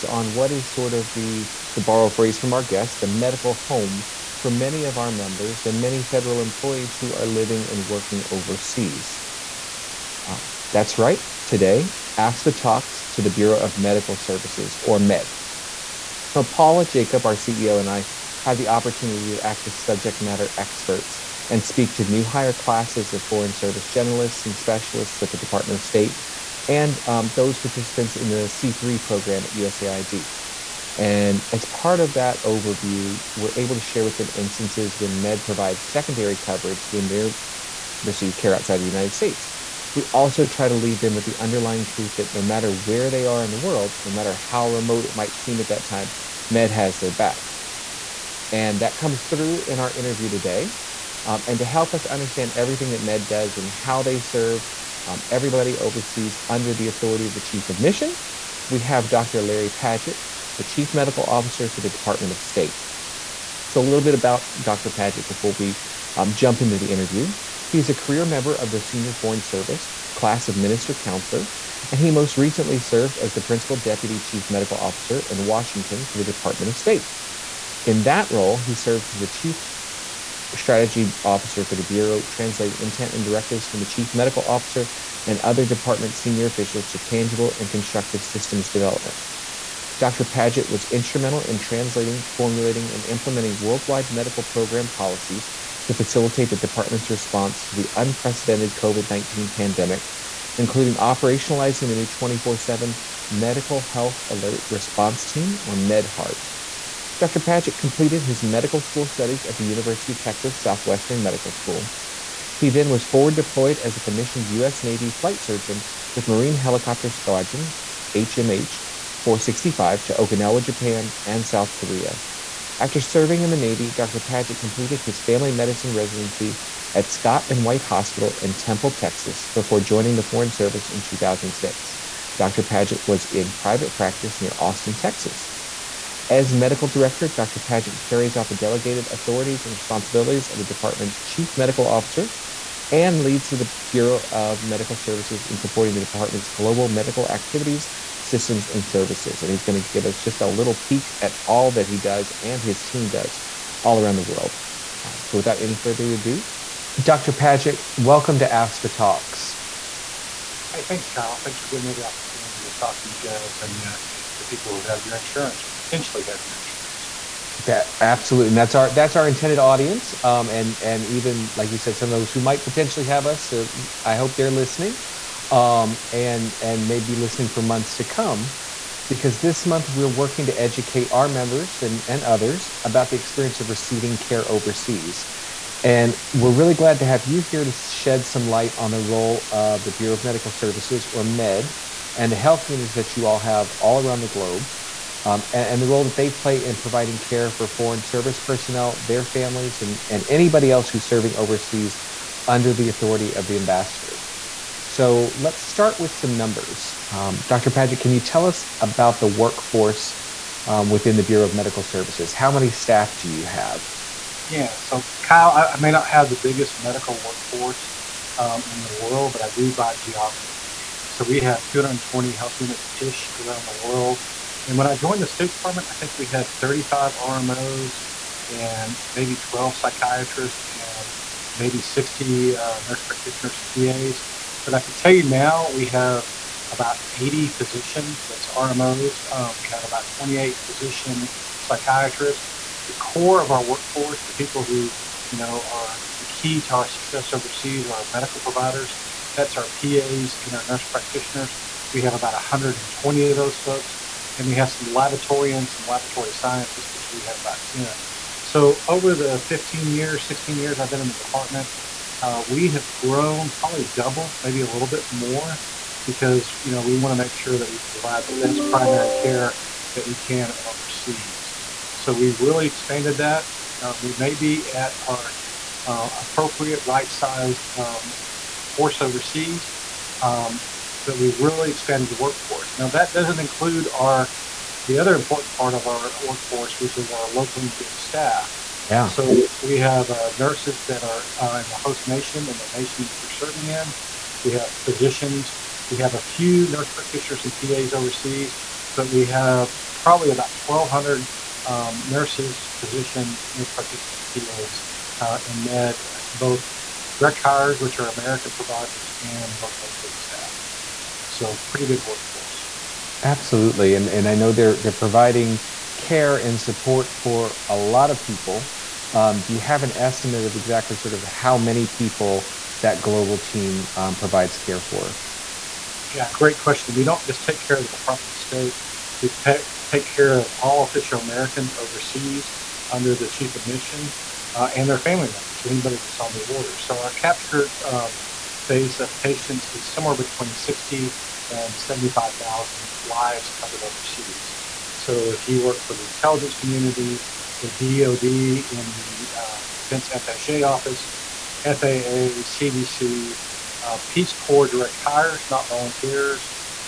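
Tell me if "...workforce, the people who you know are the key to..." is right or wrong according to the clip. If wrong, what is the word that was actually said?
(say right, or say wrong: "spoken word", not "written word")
right.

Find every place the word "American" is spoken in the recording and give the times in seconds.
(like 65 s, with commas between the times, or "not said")
308 s, 331 s.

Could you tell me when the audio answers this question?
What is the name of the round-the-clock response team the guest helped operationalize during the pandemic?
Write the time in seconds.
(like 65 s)
105 s.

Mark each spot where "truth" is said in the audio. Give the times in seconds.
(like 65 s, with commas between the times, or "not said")
41 s.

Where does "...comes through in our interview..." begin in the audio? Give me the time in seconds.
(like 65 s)
48 s.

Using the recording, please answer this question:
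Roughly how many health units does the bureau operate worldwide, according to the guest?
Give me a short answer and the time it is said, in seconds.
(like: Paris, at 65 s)
220, at 221 s.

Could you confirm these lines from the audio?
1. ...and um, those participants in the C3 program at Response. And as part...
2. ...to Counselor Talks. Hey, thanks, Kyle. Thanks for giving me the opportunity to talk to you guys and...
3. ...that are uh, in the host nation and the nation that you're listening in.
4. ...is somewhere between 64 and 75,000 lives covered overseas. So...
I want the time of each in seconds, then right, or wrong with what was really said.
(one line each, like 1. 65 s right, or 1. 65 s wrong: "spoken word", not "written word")
1. 26 s wrong: "USAID", not "Response"
2. 158 s wrong: "AFSPA", not "Counselor"
3. 290 s wrong: "serving", not "listening"
4. 339 s wrong: "60", not "64".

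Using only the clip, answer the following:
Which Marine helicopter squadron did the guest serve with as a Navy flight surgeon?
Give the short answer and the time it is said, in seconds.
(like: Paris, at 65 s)
HMH 465, at 118 s.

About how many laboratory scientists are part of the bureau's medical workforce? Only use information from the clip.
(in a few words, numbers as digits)
10.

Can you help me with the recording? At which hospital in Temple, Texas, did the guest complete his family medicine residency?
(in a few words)
Scott and White Hospital.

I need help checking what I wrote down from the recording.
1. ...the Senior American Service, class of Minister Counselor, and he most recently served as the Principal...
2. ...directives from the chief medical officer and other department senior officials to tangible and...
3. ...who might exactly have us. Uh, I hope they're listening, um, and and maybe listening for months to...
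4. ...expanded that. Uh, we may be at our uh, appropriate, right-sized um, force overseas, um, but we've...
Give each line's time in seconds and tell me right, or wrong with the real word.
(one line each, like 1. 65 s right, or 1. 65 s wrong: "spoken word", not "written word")
1. 68 s wrong: "Foreign", not "American"
2. 83 s right
3. 172 s wrong: "potentially", not "exactly"
4. 272 s right.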